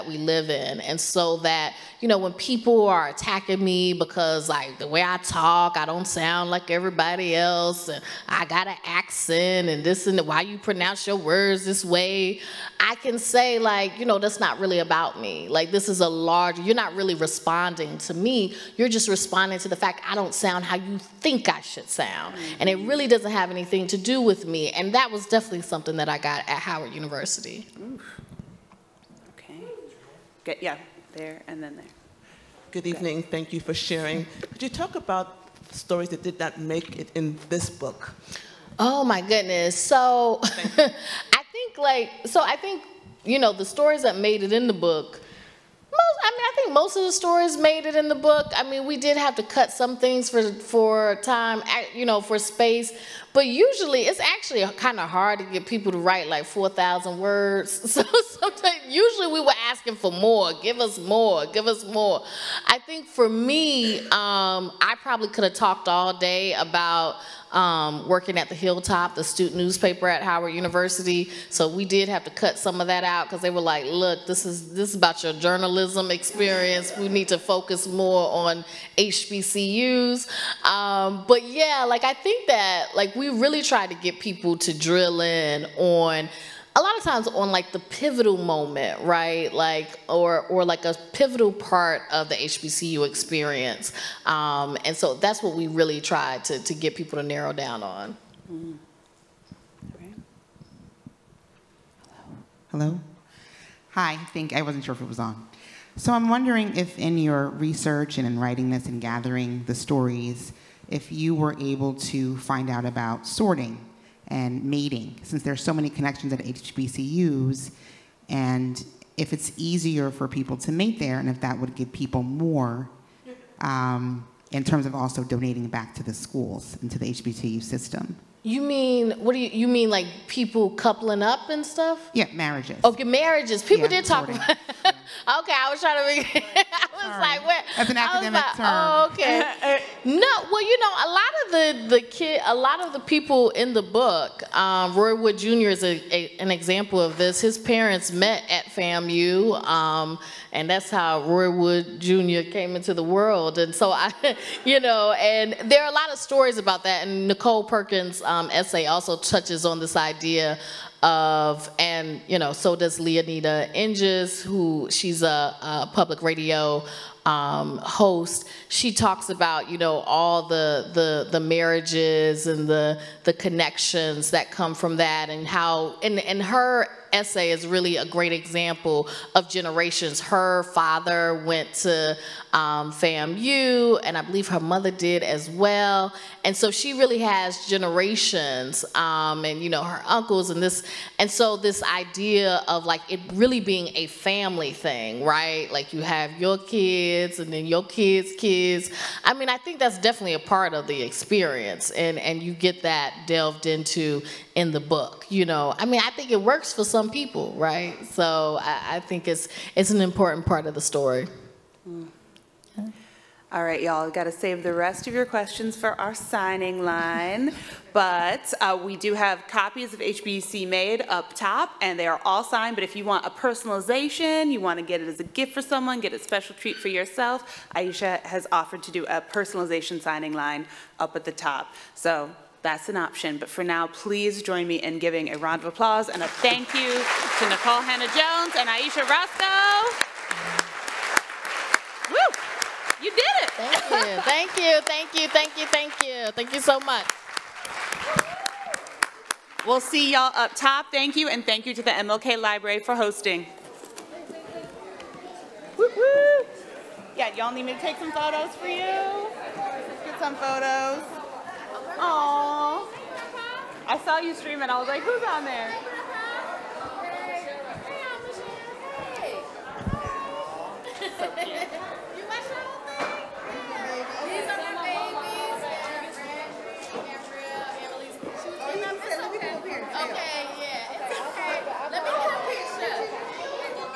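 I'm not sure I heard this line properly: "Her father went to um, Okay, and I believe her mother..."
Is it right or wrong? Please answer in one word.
wrong.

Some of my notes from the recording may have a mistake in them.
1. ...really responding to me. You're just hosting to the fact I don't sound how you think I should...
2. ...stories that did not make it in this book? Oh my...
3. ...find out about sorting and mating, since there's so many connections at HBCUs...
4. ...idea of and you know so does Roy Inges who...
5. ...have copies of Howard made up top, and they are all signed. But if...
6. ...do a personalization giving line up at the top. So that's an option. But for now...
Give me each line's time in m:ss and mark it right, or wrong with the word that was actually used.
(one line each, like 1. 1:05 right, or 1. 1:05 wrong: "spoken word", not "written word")
1. 0:16 wrong: "responding", not "hosting"
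2. 0:35 right
3. 1:52 right
4. 2:39 wrong: "Leoneda", not "Roy"
5. 3:39 wrong: "HBC", not "Howard"
6. 3:48 wrong: "signing", not "giving".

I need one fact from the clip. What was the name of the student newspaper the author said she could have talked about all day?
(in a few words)
The Hilltop.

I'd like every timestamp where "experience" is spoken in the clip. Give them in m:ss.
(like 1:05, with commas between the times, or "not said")
1:16, 1:33, 3:21.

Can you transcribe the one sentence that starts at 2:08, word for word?
You mean what do you you mean like people coupling up and stuff?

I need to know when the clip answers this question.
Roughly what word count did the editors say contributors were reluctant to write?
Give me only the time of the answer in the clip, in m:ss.
0:56.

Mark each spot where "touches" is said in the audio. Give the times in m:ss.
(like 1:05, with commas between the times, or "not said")
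2:39.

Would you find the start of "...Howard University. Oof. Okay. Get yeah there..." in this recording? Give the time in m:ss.
0:26.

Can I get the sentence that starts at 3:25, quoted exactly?
You know, I mean, I think it works for some people, right?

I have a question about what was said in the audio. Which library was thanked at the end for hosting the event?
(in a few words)
MLK Library.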